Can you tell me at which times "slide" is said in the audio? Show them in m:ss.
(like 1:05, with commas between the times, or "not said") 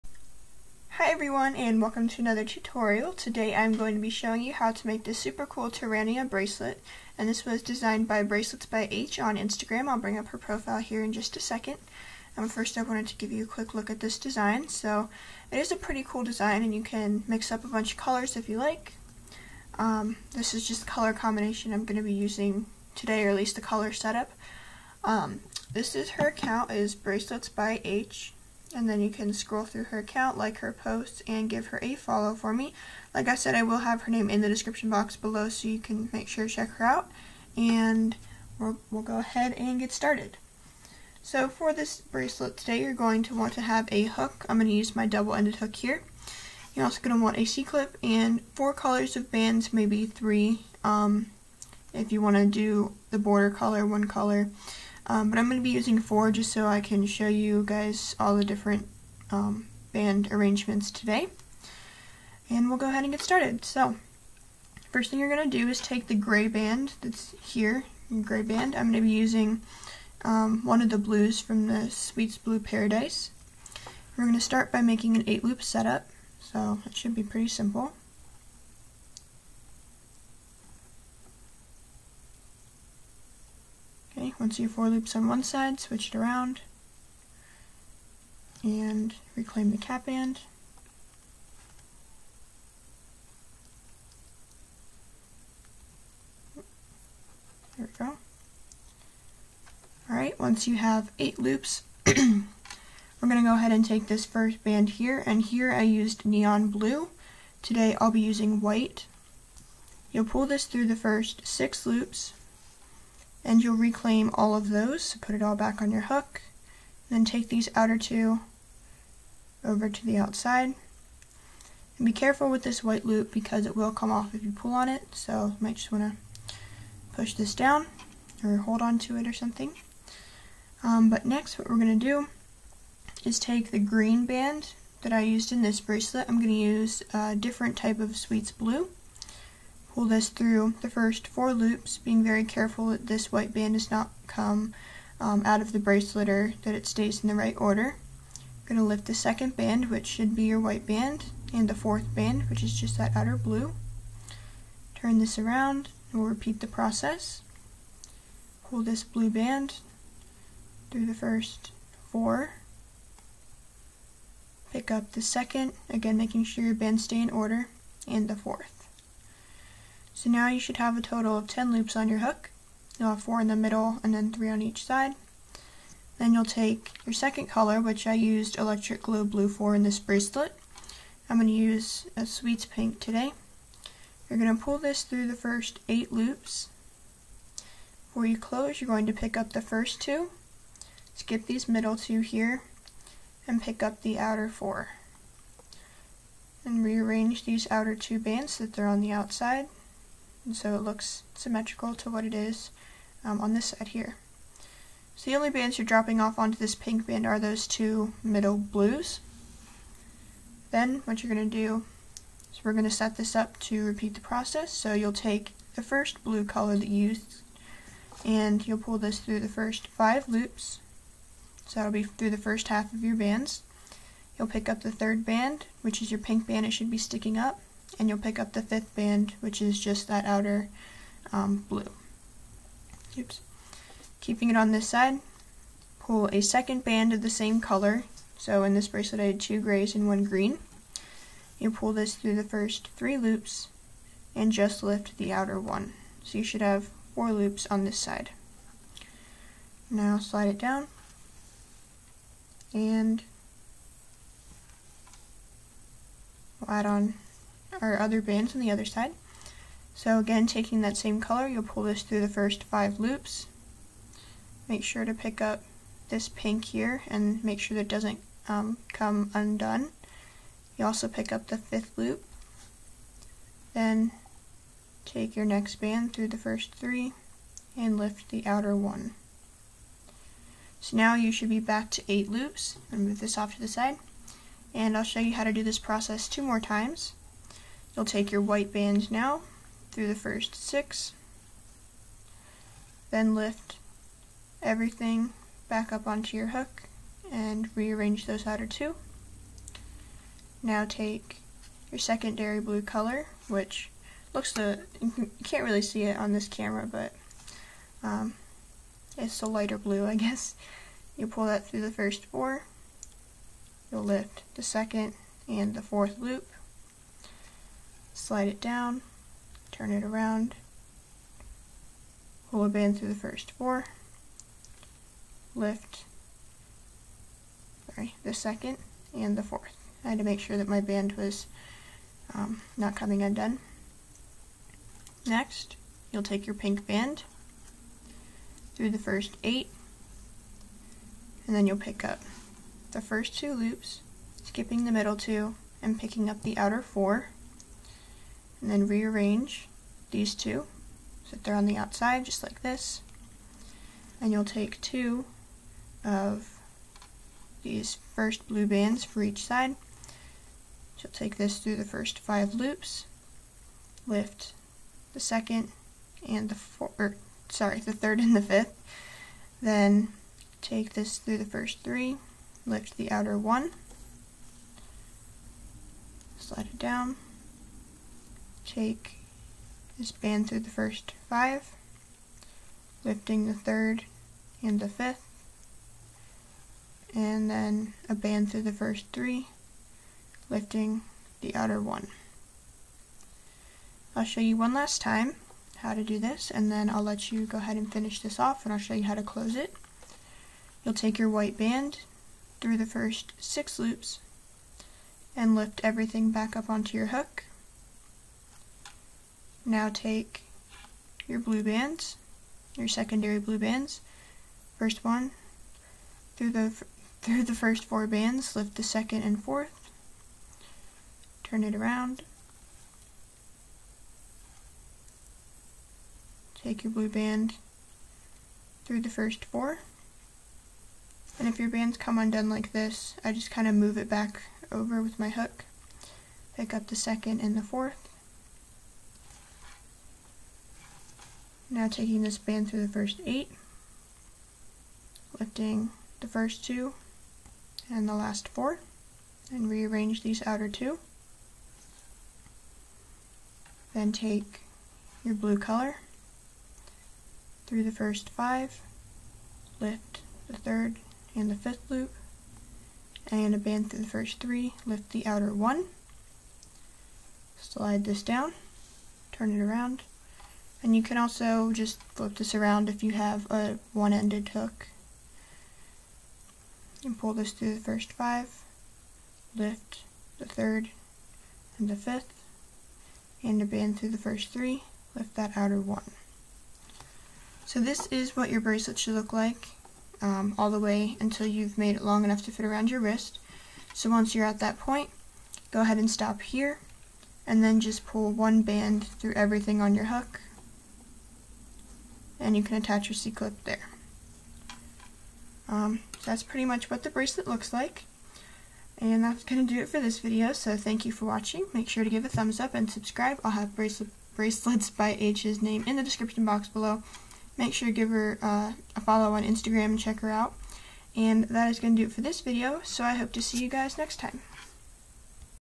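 4:10, 5:18, 6:16, 7:47.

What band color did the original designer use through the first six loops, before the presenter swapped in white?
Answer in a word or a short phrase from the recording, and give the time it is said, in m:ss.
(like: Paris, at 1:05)
neon blue, at 1:46.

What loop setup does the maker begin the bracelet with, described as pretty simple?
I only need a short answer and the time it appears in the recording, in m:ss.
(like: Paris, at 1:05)
8-loop setup, at 1:15.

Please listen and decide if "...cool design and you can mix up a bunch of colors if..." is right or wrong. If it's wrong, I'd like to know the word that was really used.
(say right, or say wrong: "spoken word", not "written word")
right.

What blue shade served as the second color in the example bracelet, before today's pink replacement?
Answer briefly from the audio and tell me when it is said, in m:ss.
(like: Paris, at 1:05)
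electric glow blue, at 2:58.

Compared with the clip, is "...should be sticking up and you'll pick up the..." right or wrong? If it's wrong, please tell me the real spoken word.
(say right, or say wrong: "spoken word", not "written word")
right.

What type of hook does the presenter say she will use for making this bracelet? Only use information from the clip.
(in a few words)
double-ended hook.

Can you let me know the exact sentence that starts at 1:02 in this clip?
And we'll go ahead and get started.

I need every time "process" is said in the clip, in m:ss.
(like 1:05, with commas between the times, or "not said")
2:36, 3:34, 4:45.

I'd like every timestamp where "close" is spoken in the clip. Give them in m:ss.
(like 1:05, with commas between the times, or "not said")
3:08, 6:39.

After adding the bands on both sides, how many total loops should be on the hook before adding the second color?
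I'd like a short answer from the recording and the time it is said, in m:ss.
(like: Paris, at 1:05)
10, at 2:51.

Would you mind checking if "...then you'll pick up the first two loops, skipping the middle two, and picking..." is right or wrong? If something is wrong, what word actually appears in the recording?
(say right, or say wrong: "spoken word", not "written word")
right.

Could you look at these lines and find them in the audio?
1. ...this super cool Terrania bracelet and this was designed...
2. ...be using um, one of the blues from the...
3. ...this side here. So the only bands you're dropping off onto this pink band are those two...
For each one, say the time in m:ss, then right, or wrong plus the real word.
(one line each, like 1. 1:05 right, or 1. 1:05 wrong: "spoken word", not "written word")
1. 0:05 right
2. 1:09 right
3. 3:23 right.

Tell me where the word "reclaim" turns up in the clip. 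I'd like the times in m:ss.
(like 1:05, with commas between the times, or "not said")
1:29, 1:53.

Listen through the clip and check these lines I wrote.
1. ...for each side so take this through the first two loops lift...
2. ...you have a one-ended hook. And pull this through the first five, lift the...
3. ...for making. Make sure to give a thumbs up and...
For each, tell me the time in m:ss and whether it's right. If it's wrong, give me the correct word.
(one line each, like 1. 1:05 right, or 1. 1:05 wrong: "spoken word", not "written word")
1. 5:59 wrong: "five", not "two"
2. 7:53 right
3. 8:31 wrong: "watching", not "making".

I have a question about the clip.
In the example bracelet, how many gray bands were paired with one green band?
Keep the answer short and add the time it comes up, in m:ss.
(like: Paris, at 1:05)
2, at 3:59.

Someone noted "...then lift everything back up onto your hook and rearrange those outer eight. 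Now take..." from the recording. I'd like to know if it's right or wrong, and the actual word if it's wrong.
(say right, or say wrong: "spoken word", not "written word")
wrong: "two", not "eight".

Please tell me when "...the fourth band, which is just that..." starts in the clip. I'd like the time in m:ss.
2:31.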